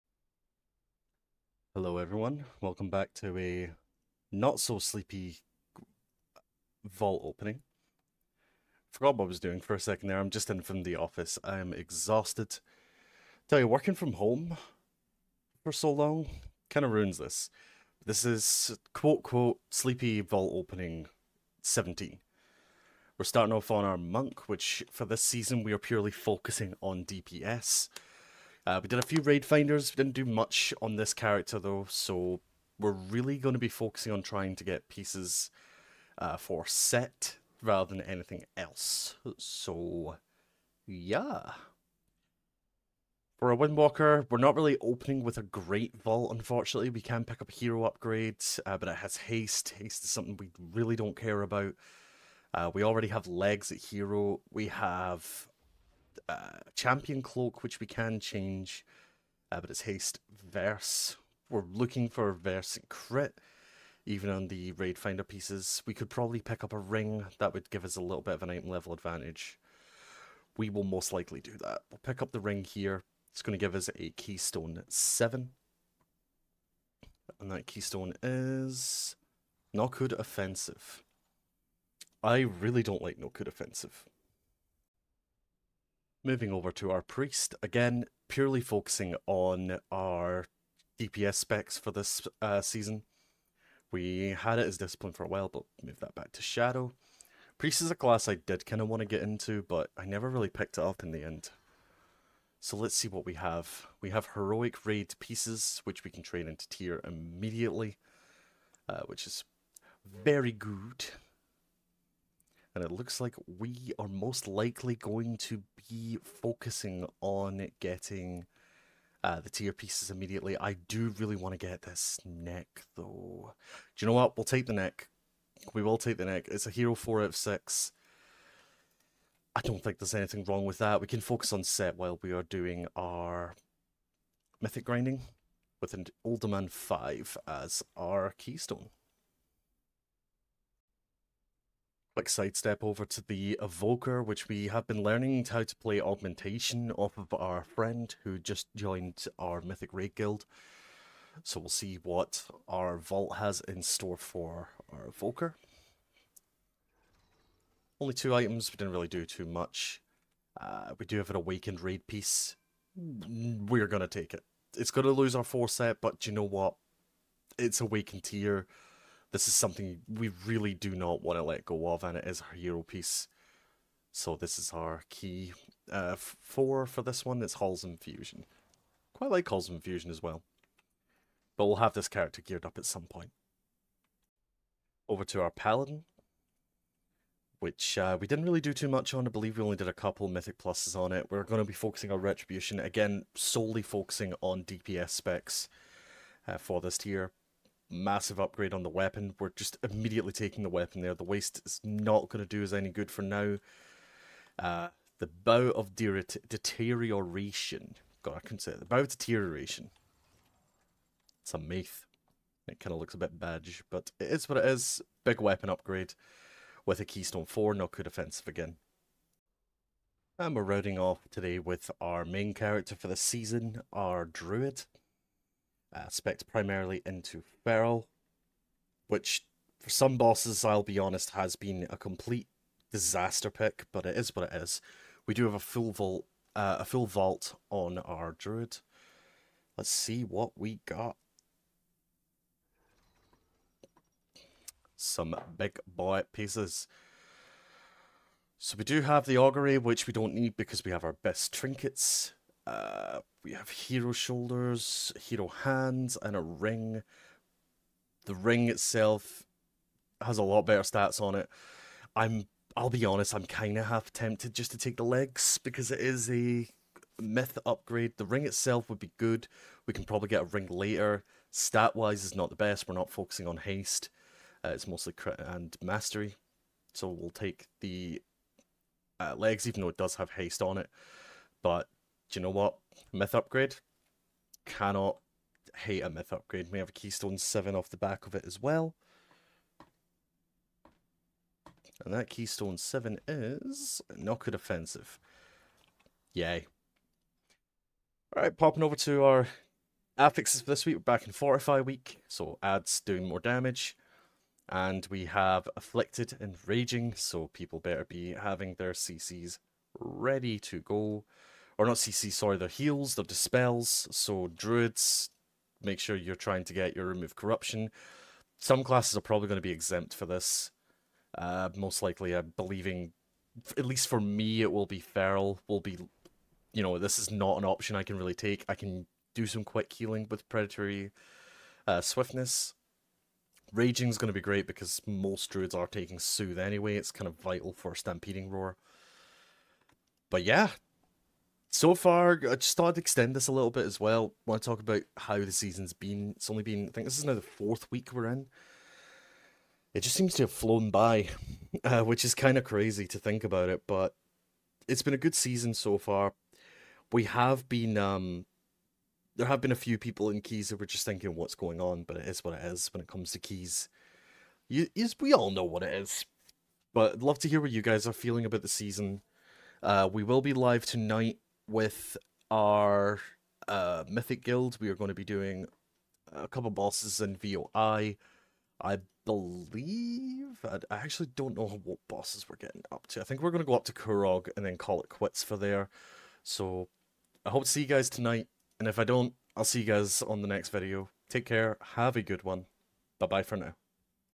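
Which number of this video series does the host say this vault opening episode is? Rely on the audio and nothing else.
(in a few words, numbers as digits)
17.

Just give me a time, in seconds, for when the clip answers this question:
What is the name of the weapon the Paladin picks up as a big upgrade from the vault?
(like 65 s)
208 s.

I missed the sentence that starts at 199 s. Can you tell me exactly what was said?
We're just immediately taking the weapon there.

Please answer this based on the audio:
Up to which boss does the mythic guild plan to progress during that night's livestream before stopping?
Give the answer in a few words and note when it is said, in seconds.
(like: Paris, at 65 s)
Kurog, at 383 s.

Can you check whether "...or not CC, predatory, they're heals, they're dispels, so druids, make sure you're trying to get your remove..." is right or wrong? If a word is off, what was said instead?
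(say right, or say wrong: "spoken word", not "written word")
wrong: "sorry", not "predatory".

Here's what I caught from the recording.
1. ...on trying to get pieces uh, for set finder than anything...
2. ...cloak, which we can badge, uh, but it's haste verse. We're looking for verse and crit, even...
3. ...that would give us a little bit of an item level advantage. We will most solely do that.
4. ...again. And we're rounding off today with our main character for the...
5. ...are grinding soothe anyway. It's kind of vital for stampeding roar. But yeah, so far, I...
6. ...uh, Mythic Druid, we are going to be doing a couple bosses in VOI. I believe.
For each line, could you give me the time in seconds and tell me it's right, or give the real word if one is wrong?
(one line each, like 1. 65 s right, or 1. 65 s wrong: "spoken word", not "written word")
1. 34 s wrong: "rather", not "finder"
2. 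57 s wrong: "change", not "badge"
3. 67 s wrong: "likely", not "solely"
4. 218 s right
5. 335 s wrong: "taking", not "grinding"
6. 373 s wrong: "Guild", not "Druid".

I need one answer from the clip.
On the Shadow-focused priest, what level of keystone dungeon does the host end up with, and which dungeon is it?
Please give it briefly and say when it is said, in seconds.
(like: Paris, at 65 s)
Uldaman 5, at 136 s.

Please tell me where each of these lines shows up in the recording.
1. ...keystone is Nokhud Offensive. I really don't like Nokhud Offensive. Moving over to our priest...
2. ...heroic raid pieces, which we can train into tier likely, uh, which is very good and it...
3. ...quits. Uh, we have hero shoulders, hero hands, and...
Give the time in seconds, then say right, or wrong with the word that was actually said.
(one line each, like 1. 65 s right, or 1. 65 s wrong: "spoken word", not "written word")
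1. 77 s right
2. 104 s wrong: "immediately", not "likely"
3. 251 s wrong: "trinkets", not "quits".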